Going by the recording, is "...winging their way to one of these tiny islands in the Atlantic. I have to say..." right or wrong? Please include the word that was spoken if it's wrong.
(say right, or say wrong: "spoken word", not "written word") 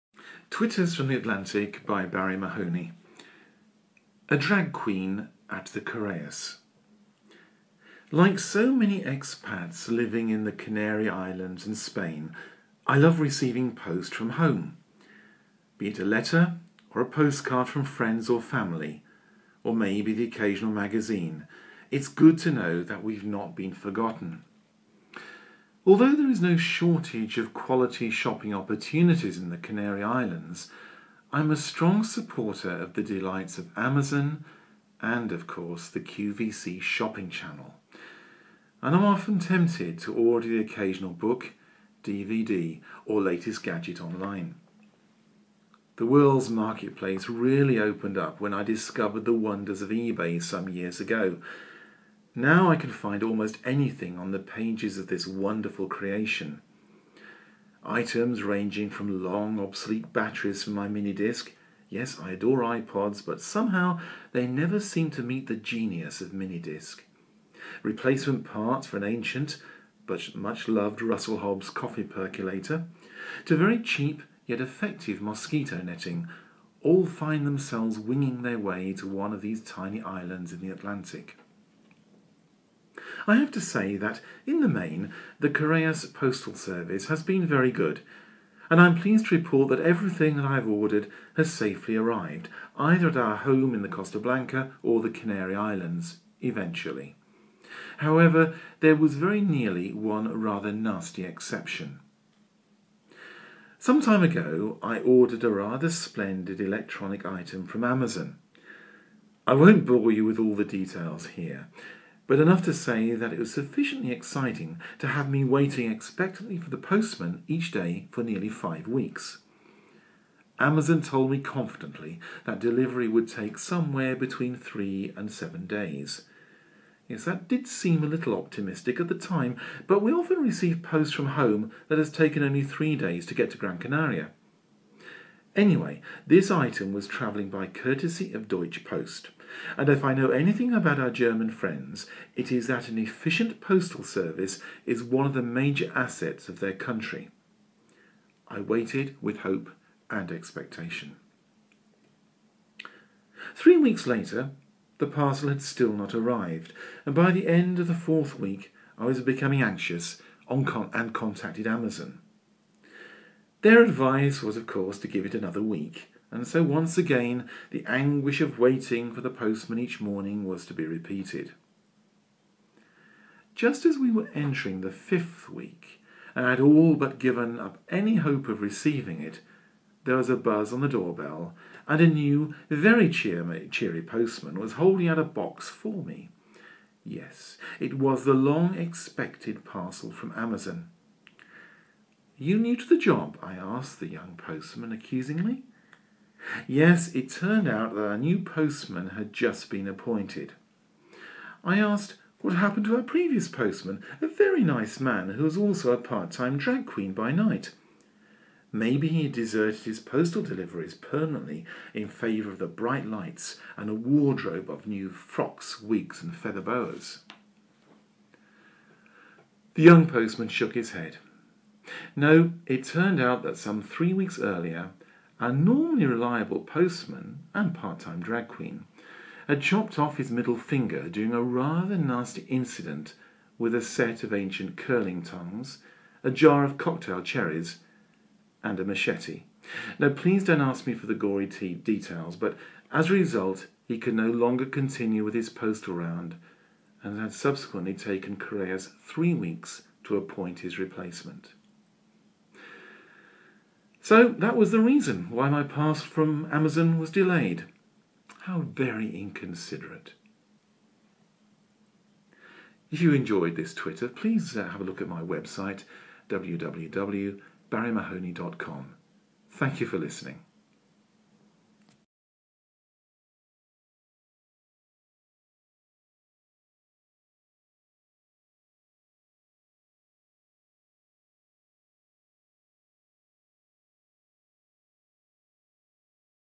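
right.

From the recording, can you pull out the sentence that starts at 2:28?
I waited with hope and expectation.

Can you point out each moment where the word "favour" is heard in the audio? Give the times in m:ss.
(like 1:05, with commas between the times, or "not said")
3:32.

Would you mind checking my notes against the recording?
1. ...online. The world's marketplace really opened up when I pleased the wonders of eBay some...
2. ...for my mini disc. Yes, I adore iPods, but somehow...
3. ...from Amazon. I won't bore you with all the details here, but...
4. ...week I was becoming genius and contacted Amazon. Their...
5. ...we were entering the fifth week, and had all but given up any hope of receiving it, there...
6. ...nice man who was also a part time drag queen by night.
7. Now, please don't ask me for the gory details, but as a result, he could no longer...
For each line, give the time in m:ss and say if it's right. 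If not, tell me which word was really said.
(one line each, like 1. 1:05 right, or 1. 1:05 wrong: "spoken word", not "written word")
1. 0:44 wrong: "discovered", not "pleased"
2. 1:00 right
3. 1:47 right
4. 2:38 wrong: "anxious", not "genius"
5. 2:53 right
6. 3:24 right
7. 3:59 right.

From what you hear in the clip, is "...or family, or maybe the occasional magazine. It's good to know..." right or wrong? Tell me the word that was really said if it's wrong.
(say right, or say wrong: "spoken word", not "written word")
right.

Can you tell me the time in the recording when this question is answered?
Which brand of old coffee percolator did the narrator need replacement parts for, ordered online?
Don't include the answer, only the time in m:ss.
1:11.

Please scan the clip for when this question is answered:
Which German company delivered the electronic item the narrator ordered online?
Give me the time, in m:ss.
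2:18.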